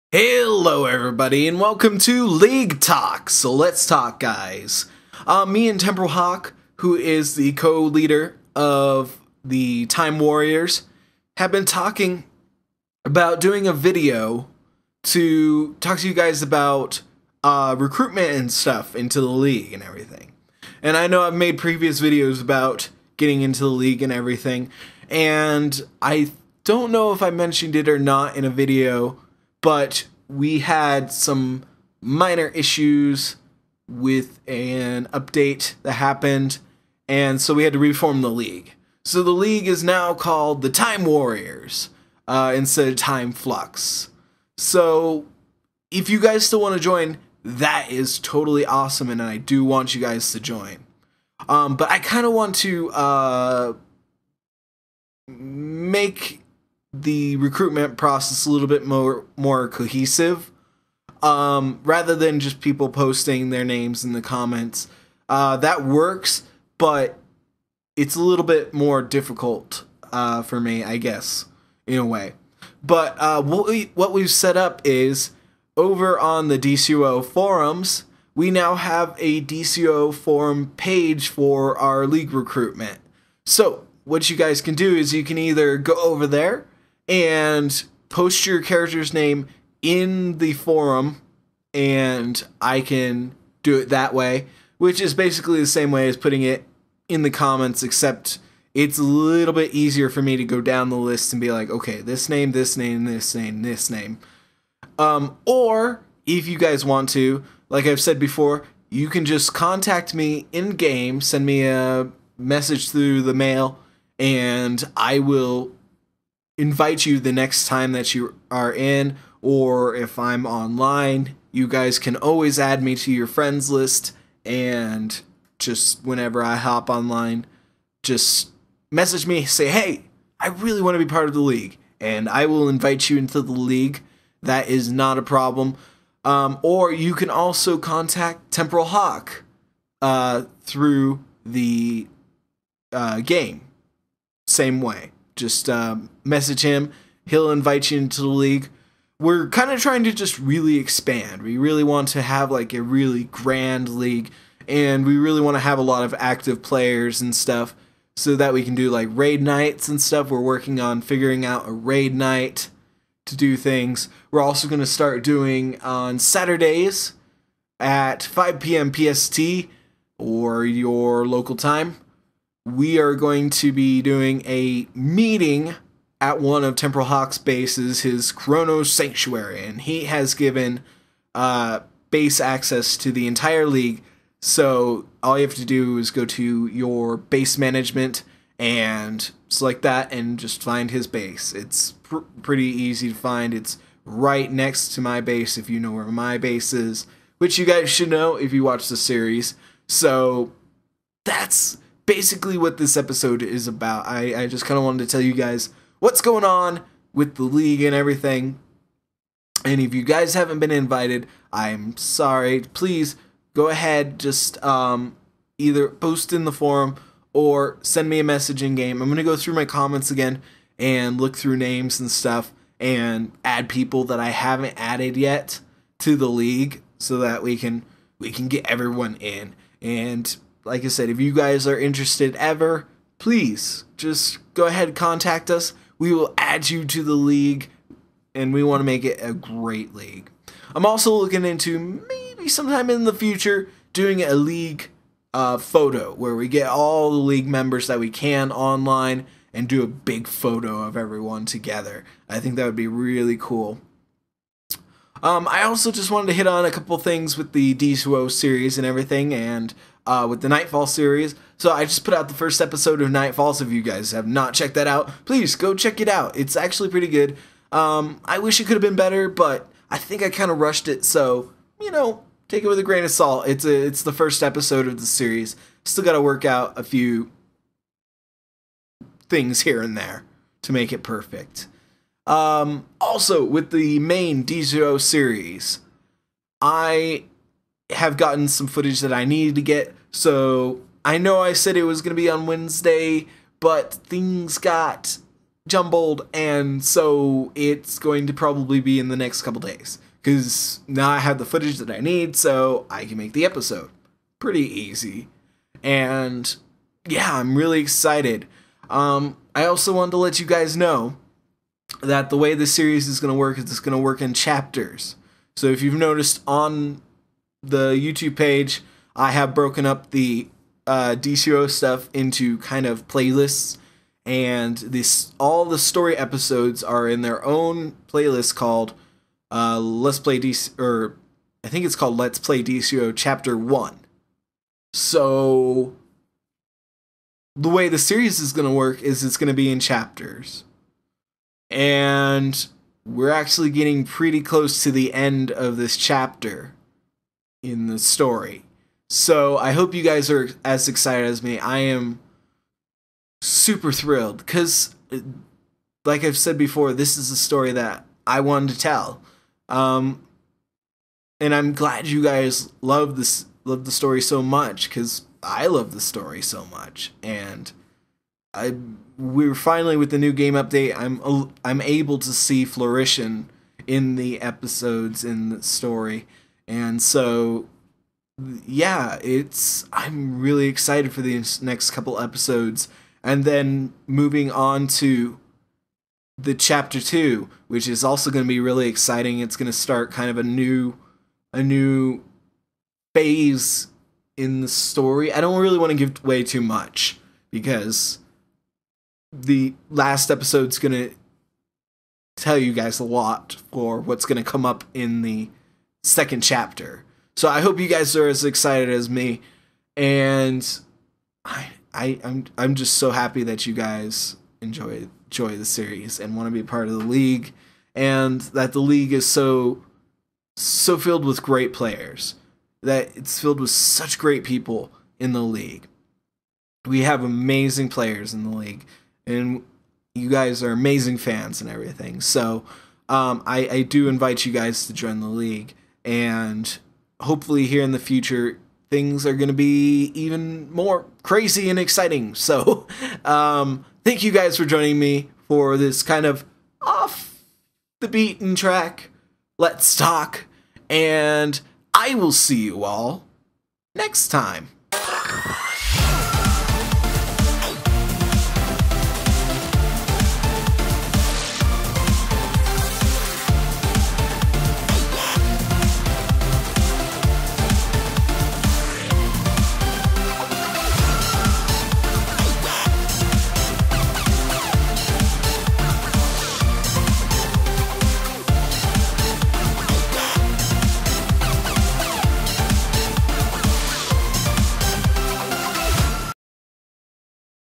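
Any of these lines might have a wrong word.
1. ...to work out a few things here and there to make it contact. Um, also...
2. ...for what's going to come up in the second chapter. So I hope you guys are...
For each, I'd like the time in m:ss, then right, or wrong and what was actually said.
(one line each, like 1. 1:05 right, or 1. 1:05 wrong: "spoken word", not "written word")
1. 4:36 wrong: "perfect", not "contact"
2. 6:43 right.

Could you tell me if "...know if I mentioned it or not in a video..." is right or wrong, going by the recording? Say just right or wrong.
right.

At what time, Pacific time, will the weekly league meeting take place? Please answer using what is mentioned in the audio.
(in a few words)
5 p.m. PST.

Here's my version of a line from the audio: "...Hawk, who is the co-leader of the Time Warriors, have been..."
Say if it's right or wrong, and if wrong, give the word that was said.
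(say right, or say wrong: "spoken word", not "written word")
right.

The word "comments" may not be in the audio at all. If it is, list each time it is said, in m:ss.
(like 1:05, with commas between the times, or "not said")
1:04, 1:37, 3:39.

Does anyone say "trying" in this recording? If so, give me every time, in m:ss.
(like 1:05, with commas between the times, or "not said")
2:29.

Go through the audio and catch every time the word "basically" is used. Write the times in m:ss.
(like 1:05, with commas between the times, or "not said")
1:35, 3:22.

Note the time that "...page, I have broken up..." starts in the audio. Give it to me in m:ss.
5:18.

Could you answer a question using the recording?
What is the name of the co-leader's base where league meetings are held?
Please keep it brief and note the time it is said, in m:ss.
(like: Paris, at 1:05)
Kronos Sanctuary, at 2:58.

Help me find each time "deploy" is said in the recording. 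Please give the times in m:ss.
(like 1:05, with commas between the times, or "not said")
not said.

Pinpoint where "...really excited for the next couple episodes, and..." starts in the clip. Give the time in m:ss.
6:20.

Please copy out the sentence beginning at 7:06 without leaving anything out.
We have amazing players in the league, and you guys are amazing fans and everything.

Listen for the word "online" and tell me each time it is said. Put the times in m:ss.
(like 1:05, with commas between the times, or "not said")
2:00, 2:06, 4:08.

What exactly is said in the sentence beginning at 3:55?
We will add you to the league, and we want to make it a great league.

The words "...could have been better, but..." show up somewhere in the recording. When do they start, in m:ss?
4:28.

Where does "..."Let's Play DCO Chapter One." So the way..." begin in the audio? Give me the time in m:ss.
5:32.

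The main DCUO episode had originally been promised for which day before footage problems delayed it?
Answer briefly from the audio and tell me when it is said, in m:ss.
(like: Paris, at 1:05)
Wednesday, at 4:52.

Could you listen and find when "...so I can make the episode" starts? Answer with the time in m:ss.
5:02.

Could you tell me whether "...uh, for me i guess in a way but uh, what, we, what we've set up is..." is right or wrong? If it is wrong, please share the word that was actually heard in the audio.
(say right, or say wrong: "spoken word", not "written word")
right.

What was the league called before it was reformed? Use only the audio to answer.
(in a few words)
Time Flux.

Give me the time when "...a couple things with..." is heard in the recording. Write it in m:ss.
4:16.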